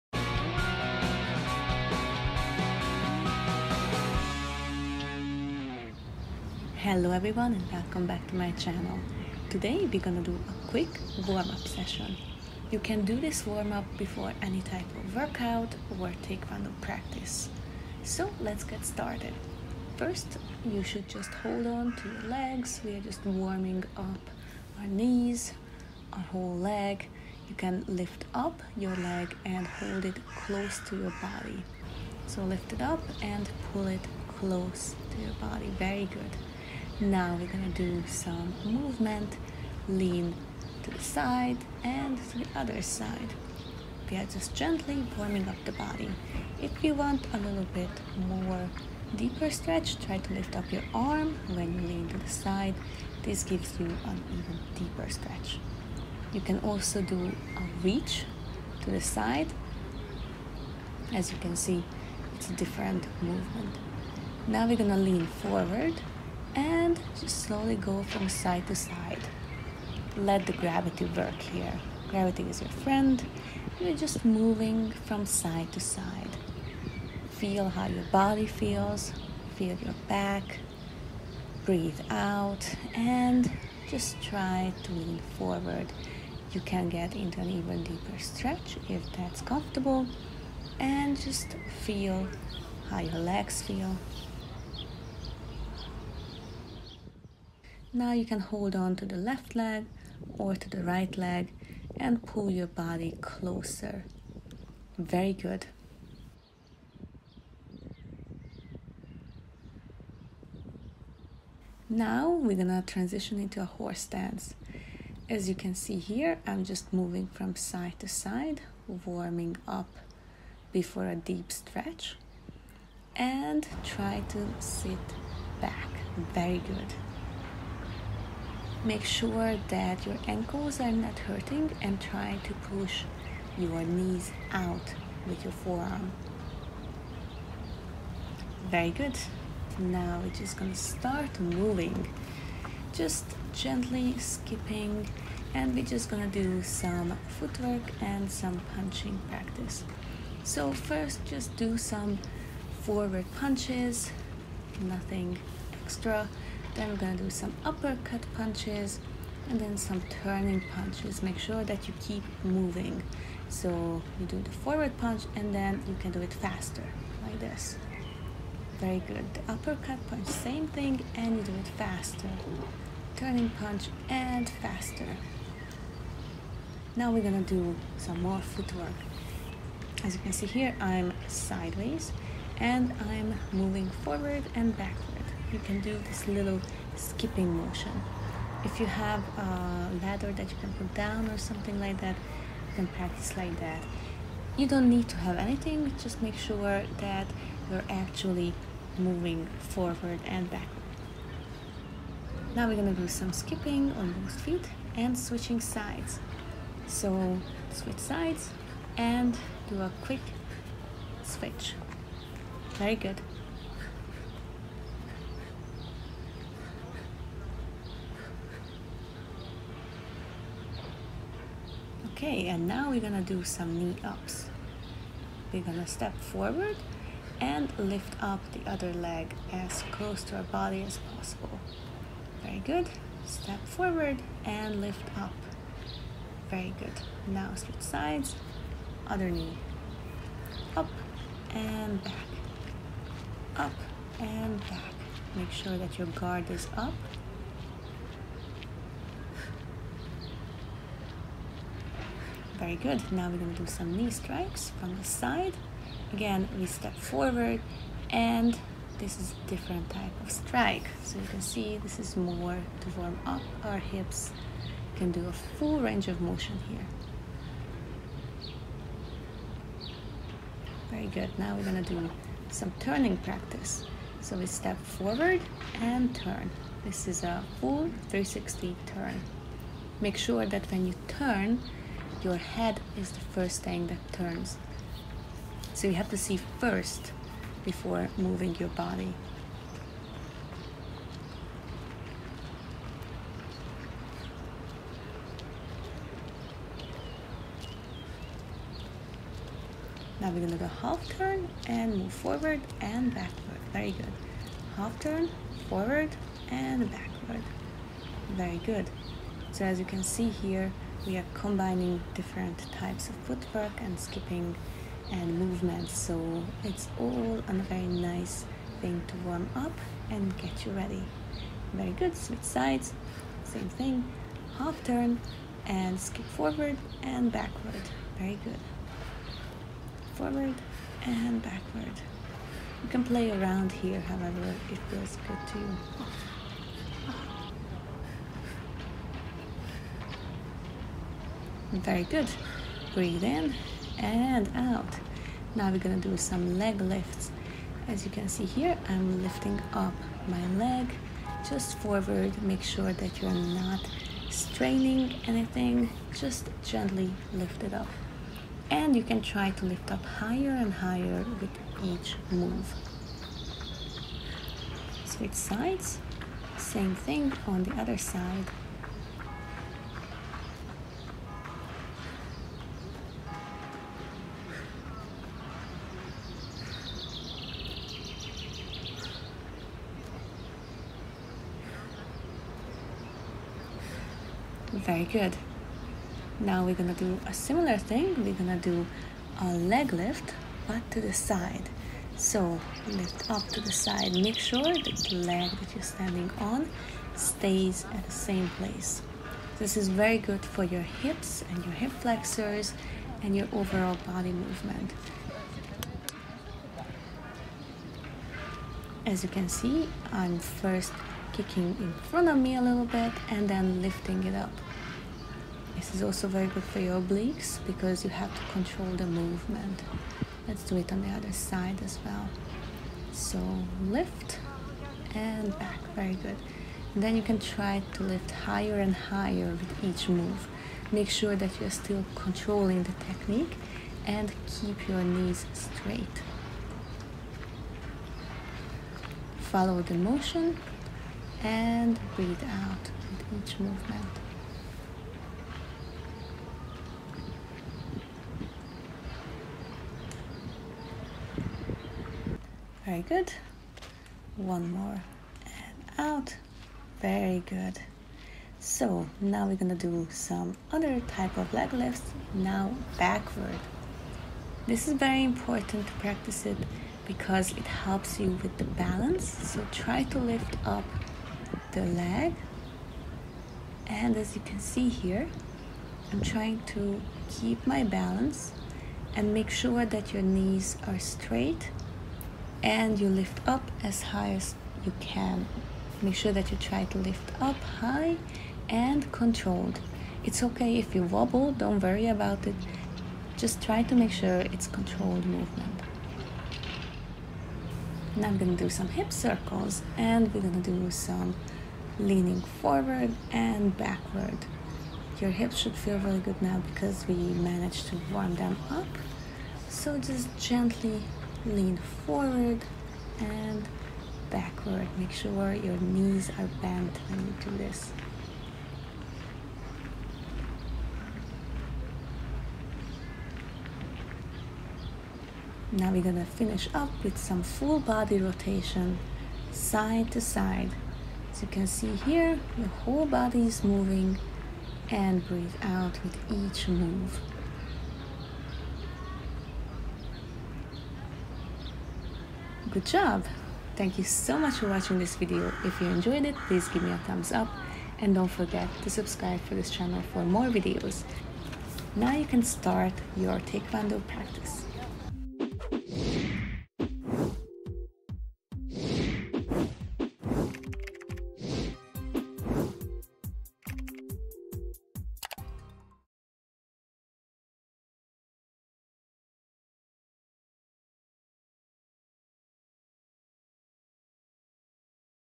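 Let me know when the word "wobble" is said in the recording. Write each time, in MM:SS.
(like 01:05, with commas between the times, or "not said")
08:11.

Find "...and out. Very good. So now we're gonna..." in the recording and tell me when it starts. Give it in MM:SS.
07:35.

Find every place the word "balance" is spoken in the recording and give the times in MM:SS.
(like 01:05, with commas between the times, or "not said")
07:48, 07:57.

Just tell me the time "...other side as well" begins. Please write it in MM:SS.
07:01.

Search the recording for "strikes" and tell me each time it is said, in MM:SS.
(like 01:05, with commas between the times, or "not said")
04:14, 04:20.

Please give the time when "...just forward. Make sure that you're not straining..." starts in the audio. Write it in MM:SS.
05:51.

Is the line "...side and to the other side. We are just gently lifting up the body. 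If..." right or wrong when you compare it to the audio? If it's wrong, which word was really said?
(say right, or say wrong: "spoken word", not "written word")
wrong: "warming", not "lifting".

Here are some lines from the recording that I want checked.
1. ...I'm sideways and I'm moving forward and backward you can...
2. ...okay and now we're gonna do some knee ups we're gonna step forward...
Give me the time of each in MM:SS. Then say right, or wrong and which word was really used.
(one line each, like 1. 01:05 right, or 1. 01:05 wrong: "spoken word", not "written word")
1. 03:00 right
2. 03:42 right.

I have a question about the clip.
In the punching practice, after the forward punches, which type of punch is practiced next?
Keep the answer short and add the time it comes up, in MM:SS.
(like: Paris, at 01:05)
Uppercut punches, at 02:37.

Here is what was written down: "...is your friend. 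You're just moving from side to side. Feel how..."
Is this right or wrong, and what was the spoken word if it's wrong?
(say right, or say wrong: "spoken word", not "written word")
right.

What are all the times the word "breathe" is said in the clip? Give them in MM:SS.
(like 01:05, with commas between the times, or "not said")
01:21, 05:42, 07:22, 08:55.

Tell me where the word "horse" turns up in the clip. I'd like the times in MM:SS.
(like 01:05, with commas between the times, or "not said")
01:53.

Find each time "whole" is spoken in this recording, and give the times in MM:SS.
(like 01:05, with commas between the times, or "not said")
00:26, 08:52.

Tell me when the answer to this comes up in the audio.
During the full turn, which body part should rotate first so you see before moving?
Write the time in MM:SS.
04:42.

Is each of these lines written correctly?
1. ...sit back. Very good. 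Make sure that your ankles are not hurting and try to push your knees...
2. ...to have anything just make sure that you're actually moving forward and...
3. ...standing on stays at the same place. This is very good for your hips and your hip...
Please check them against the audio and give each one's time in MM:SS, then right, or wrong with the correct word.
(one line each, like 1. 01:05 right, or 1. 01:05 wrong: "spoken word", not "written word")
1. 02:04 right
2. 03:15 right
3. 06:35 right.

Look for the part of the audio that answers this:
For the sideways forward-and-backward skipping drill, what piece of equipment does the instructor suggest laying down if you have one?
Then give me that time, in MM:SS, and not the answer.
03:10.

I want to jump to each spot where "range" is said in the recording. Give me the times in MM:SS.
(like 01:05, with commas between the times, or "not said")
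04:25.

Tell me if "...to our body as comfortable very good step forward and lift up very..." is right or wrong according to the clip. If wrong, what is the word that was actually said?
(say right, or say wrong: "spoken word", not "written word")
wrong: "possible", not "comfortable".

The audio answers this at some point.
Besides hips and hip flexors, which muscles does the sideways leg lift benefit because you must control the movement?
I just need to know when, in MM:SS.
06:57.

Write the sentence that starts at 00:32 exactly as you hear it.
So lift it up and pull it close to your body.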